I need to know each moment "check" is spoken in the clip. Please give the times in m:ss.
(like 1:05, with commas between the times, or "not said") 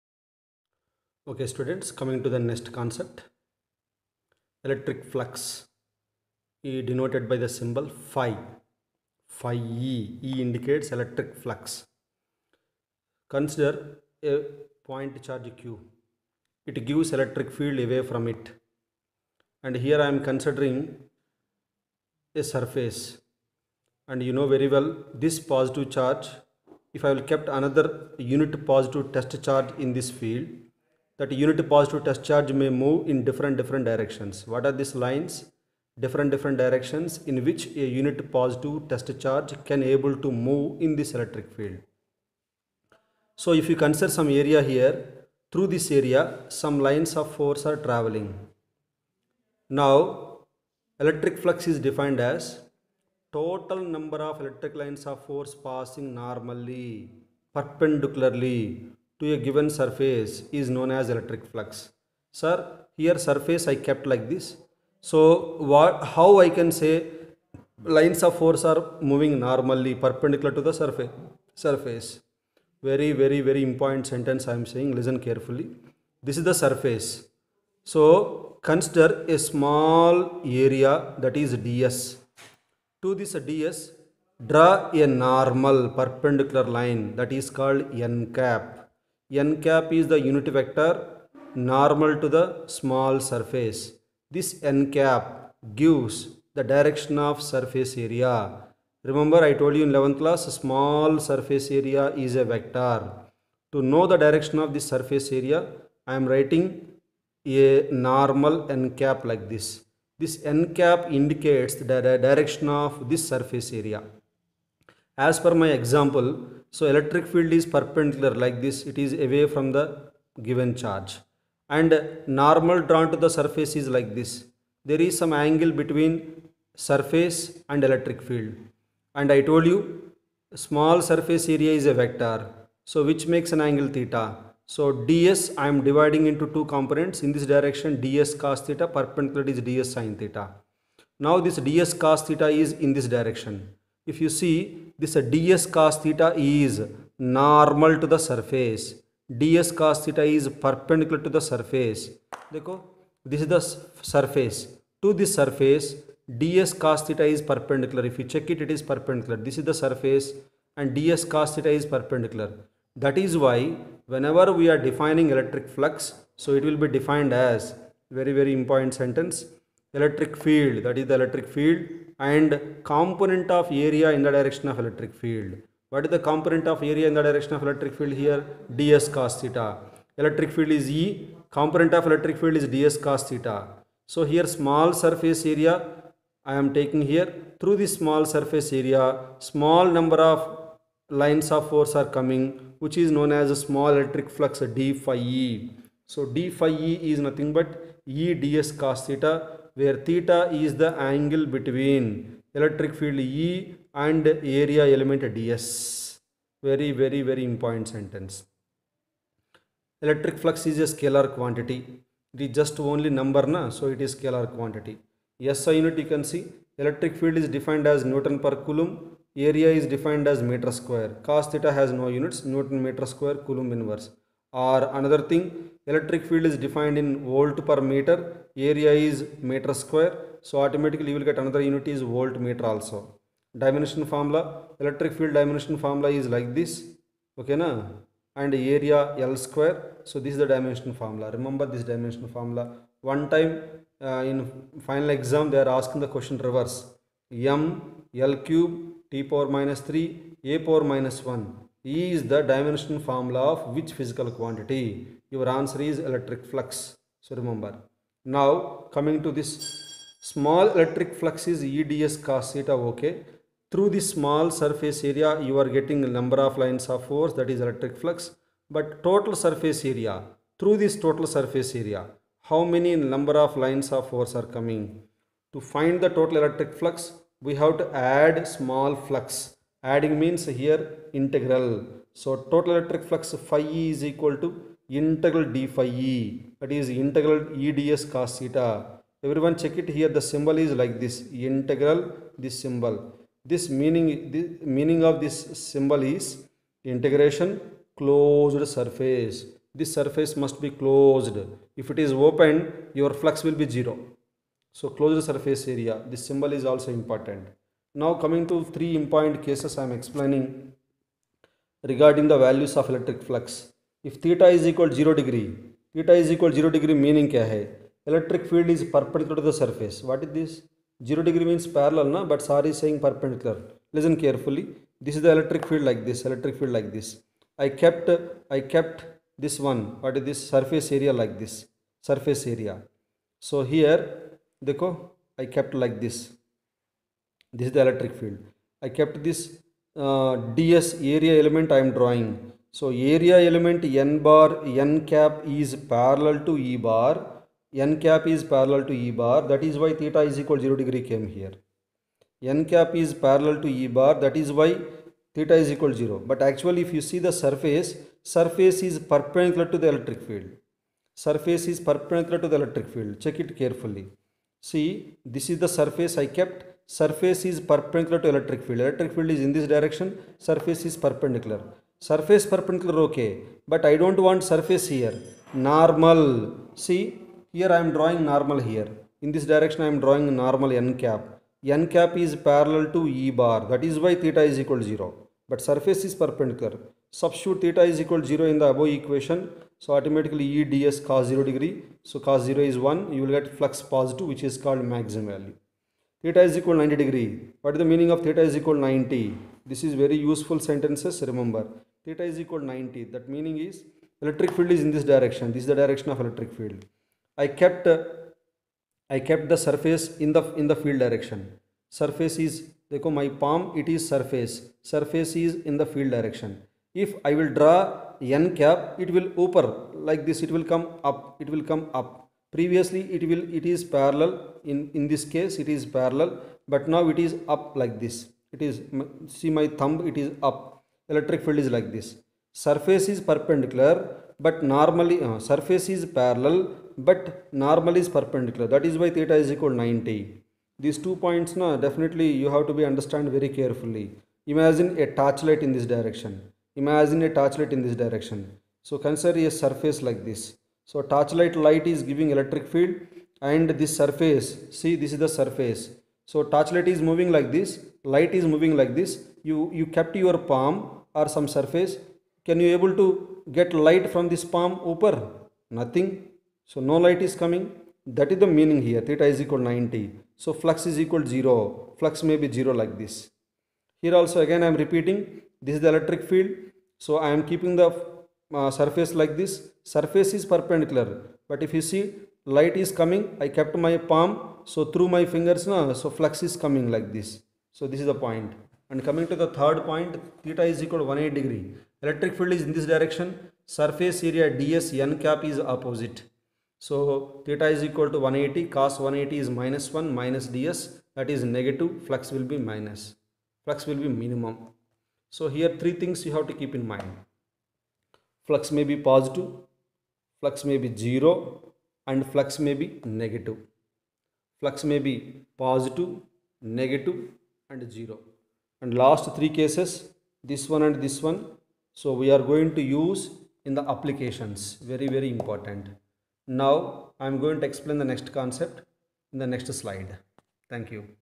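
2:38, 4:49, 6:03.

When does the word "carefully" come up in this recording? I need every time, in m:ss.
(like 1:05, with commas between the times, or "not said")
1:15, 5:24, 6:03, 7:23.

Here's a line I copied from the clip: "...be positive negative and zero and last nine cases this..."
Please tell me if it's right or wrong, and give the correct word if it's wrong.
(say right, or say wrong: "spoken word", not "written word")
wrong: "three", not "nine".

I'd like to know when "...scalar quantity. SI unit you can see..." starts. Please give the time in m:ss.
3:34.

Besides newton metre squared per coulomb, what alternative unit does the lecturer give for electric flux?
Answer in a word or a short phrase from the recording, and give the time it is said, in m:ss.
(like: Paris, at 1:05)
volt meter, at 3:52.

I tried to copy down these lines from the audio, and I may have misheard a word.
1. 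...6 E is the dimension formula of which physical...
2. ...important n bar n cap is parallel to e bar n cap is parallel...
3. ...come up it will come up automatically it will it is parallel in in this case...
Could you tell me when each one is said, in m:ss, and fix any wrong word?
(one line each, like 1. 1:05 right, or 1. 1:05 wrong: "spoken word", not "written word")
1. 4:11 wrong: "1", not "6"
2. 5:43 wrong: "element", not "important"
3. 7:00 wrong: "previously", not "automatically".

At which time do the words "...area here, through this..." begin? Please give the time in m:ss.
0:44.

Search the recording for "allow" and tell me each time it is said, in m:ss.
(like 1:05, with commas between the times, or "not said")
not said.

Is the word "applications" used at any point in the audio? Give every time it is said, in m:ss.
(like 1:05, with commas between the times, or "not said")
8:43.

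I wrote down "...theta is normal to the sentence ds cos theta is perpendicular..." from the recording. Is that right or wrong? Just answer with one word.
wrong.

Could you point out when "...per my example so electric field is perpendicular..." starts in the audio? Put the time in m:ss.
1:55.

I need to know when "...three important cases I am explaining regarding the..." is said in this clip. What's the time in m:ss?
5:08.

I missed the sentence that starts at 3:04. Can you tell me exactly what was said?
So here small surface area I am taking here.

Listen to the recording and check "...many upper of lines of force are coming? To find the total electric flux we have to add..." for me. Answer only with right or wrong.
wrong.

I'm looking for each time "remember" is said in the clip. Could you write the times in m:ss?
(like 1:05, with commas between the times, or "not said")
1:39, 4:01, 4:17, 6:41.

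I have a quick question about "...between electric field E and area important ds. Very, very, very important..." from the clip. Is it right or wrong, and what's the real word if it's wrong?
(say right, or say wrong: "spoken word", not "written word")
wrong: "element", not "important".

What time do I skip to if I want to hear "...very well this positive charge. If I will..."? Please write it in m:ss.
0:24.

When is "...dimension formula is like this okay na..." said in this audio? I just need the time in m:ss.
3:55.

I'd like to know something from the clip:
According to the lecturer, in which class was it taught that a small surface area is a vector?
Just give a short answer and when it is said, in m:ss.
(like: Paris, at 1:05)
11th class, at 1:39.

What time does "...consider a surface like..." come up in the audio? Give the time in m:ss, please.
7:29.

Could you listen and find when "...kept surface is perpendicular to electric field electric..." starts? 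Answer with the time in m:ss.
6:06.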